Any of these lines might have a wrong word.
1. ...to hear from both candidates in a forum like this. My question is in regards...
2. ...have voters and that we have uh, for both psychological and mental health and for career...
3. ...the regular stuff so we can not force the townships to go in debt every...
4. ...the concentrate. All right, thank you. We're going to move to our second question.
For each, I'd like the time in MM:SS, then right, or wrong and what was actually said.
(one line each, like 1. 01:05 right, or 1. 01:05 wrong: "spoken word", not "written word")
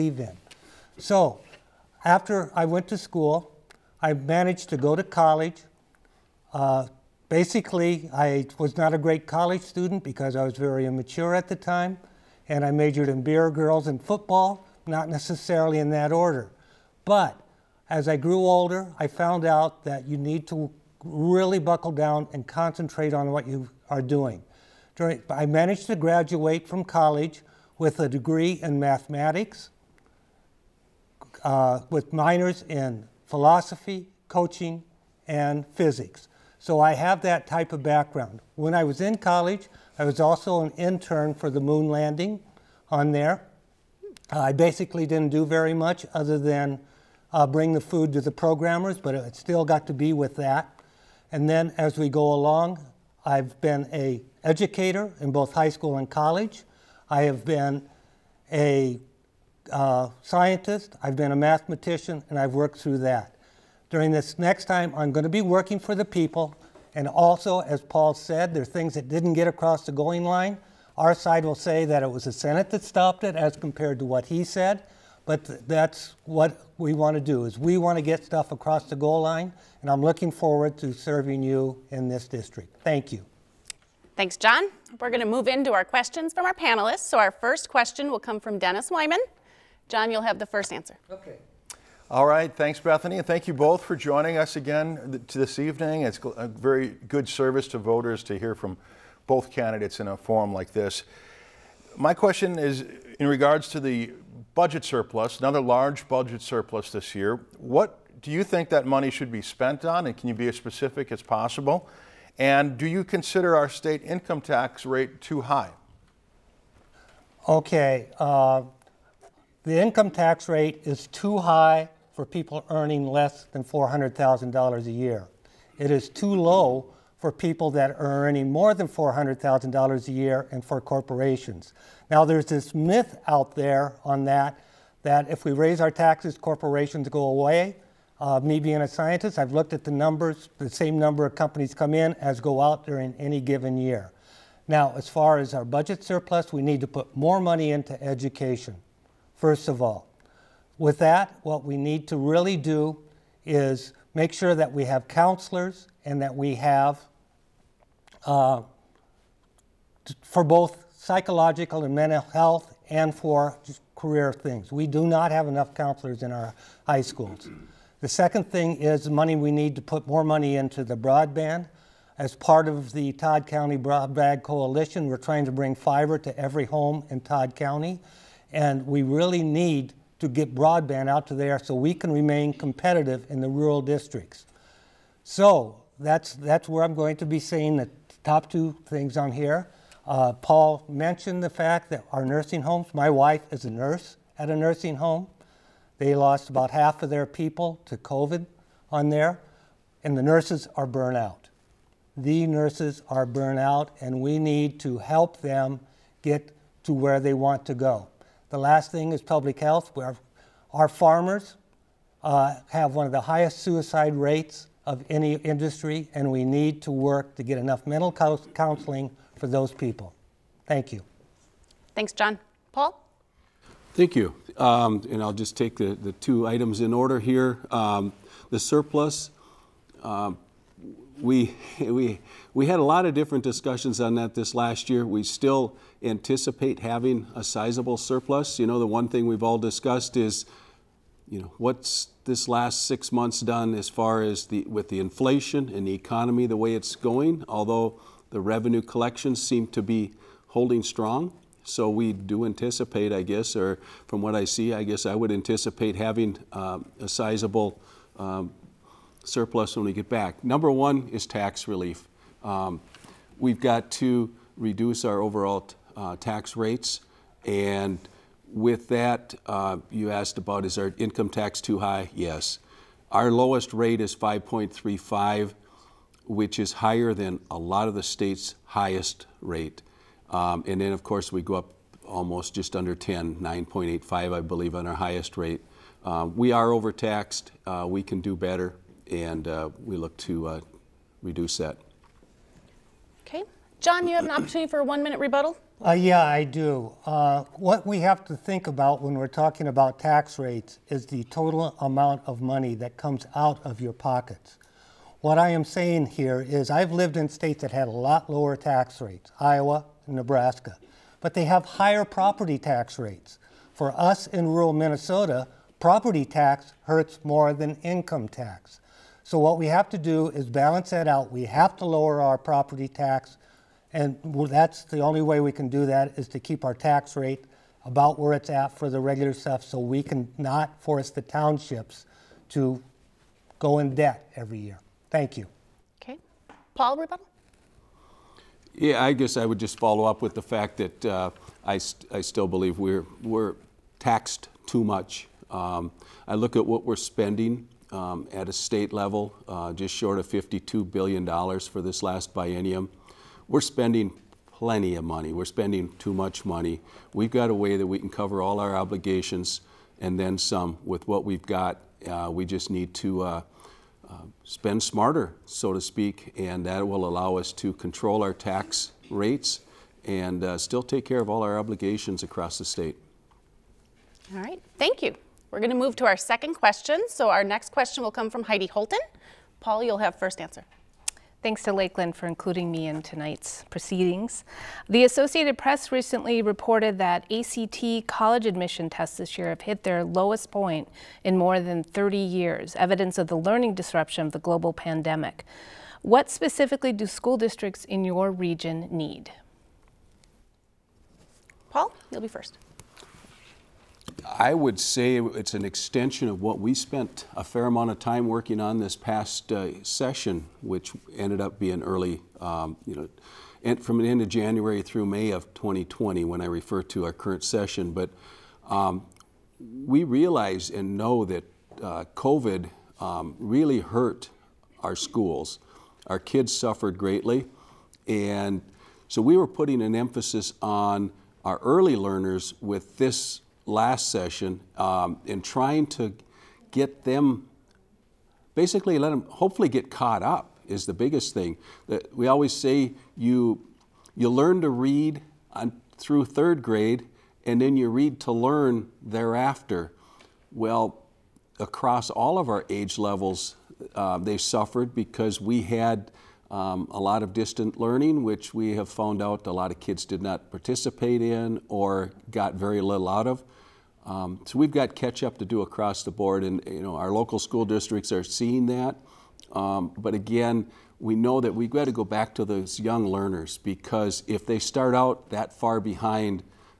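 1. 01:38 right
2. 02:34 wrong: "counselors", not "voters"
3. 05:28 right
4. 06:12 wrong: "state", not "concentrate".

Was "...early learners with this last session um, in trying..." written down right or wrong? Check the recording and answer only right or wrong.
right.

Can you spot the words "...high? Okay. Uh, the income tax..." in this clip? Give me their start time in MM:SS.
01:55.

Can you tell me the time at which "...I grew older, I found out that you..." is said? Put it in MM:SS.
00:18.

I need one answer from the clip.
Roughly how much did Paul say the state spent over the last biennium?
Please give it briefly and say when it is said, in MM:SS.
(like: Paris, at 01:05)
$52 billion, at 05:50.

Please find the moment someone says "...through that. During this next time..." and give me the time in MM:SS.
01:02.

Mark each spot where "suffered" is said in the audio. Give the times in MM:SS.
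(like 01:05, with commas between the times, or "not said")
07:06, 07:34.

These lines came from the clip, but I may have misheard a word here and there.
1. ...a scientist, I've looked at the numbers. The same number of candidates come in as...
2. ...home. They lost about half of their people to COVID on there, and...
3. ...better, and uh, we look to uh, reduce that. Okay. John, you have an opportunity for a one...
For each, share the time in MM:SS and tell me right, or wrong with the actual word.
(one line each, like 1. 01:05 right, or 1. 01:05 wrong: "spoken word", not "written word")
1. 02:18 wrong: "companies", not "candidates"
2. 03:14 right
3. 04:48 right.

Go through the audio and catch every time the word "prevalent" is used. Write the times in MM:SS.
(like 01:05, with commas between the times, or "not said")
not said.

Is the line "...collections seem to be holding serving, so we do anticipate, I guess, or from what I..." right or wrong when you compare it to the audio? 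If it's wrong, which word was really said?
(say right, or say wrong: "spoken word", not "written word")
wrong: "strong", not "serving".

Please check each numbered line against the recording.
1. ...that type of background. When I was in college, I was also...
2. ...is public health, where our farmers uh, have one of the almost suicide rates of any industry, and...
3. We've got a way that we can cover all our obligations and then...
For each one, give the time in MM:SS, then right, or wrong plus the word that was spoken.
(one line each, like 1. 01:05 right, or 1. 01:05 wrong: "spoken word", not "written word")
1. 00:37 right
2. 03:29 wrong: "highest", not "almost"
3. 05:57 right.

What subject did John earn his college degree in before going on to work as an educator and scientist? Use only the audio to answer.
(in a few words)
Mathematics.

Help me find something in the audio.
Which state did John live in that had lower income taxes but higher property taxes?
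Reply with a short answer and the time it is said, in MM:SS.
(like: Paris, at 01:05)
Iowa, at 05:09.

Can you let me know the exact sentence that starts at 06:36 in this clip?
What specifically do school districts in your region need?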